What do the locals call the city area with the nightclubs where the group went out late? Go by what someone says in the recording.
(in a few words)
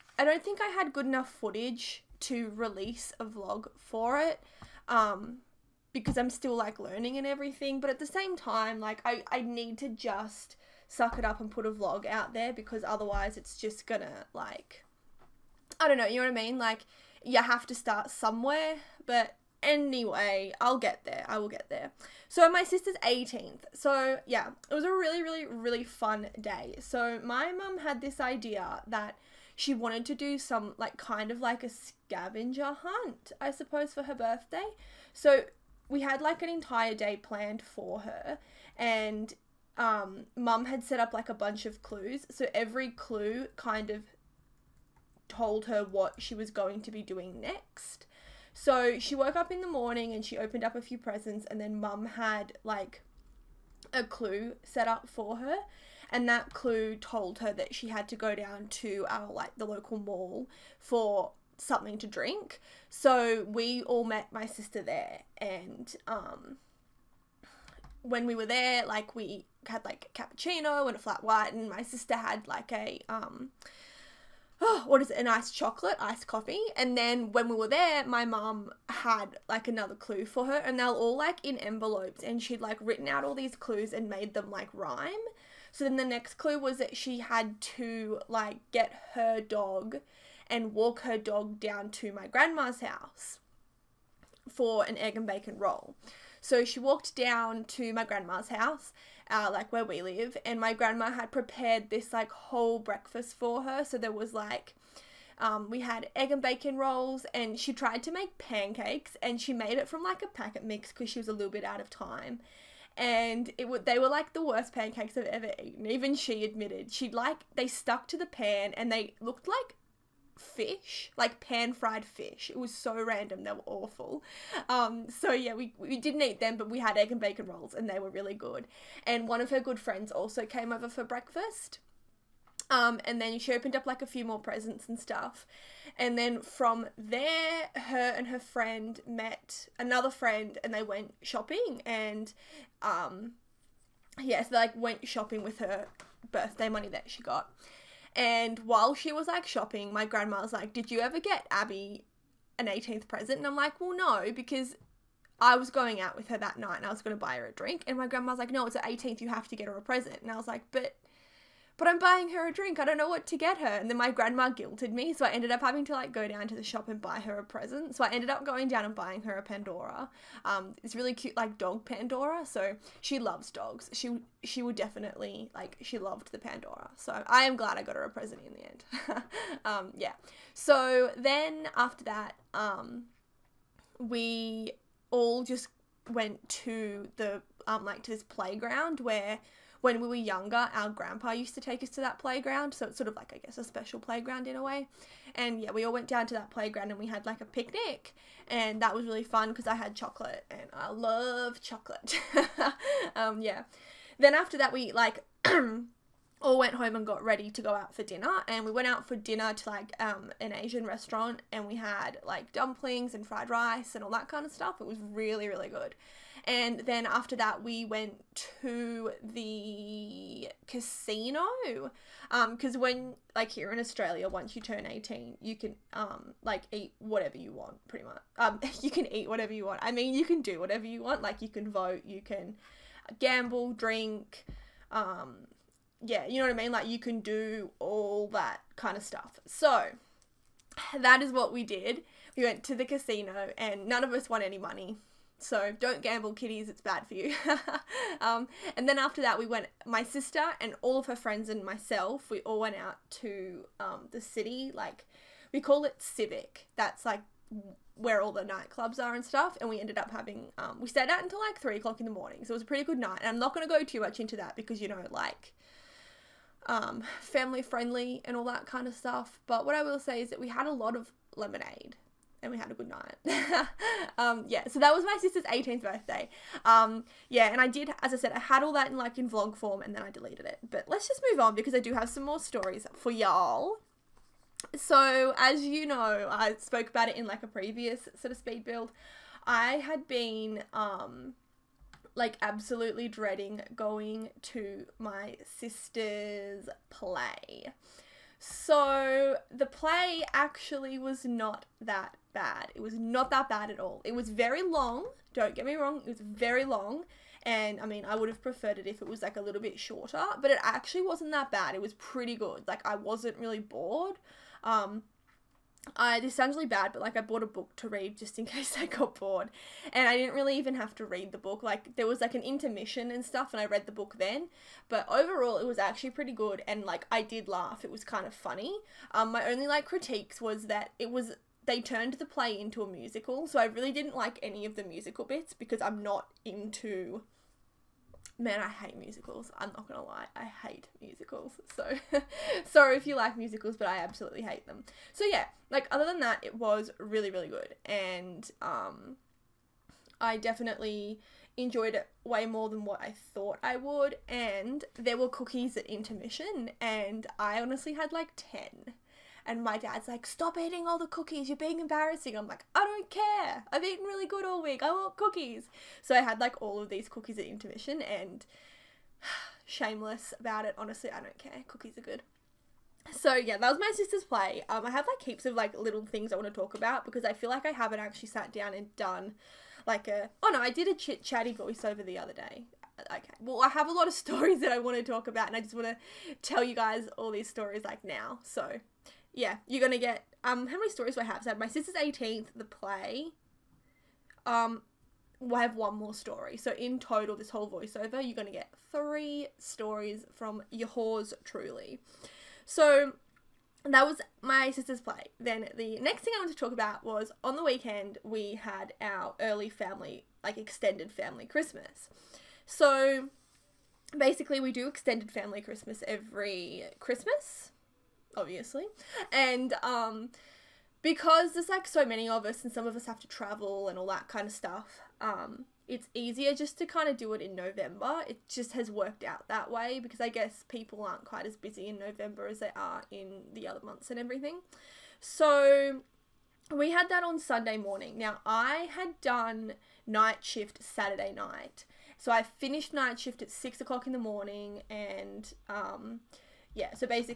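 Civic.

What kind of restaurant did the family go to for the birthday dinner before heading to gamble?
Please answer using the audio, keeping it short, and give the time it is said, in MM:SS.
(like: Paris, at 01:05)
Asian restaurant, at 03:30.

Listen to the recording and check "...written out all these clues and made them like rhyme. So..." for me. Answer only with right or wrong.
right.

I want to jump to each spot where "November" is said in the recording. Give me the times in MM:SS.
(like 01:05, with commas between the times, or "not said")
07:07, 07:11.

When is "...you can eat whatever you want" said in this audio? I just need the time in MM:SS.
03:48.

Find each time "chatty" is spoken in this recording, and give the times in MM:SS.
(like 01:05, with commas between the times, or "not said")
06:21.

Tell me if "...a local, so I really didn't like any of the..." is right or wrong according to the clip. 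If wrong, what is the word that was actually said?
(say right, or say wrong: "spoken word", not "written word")
wrong: "musical", not "local".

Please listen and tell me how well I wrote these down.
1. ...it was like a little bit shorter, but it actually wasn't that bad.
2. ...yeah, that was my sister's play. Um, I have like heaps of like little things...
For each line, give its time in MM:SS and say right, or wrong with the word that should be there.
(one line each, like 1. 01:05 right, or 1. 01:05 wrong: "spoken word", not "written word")
1. 05:08 right
2. 06:13 right.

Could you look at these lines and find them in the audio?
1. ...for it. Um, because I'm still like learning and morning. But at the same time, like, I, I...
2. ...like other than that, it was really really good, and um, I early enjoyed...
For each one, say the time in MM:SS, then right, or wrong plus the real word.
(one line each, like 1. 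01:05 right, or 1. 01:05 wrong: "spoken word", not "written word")
1. 00:03 wrong: "everything", not "morning"
2. 05:45 wrong: "definitely", not "early".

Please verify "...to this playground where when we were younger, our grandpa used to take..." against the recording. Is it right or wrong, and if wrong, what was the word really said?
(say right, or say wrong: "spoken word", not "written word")
right.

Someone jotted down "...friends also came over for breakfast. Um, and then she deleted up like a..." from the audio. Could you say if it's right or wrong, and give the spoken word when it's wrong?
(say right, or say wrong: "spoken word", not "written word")
wrong: "opened", not "deleted".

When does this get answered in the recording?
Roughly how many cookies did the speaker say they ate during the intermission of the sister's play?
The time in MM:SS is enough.
05:58.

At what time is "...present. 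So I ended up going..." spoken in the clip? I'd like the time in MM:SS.
02:47.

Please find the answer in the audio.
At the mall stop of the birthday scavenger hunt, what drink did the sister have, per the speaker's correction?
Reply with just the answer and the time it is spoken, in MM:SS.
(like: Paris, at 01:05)
iced coffee, at 01:15.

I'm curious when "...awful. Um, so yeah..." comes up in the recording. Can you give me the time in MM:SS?
02:03.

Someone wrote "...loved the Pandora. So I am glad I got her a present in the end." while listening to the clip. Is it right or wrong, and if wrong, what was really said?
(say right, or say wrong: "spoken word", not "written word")
right.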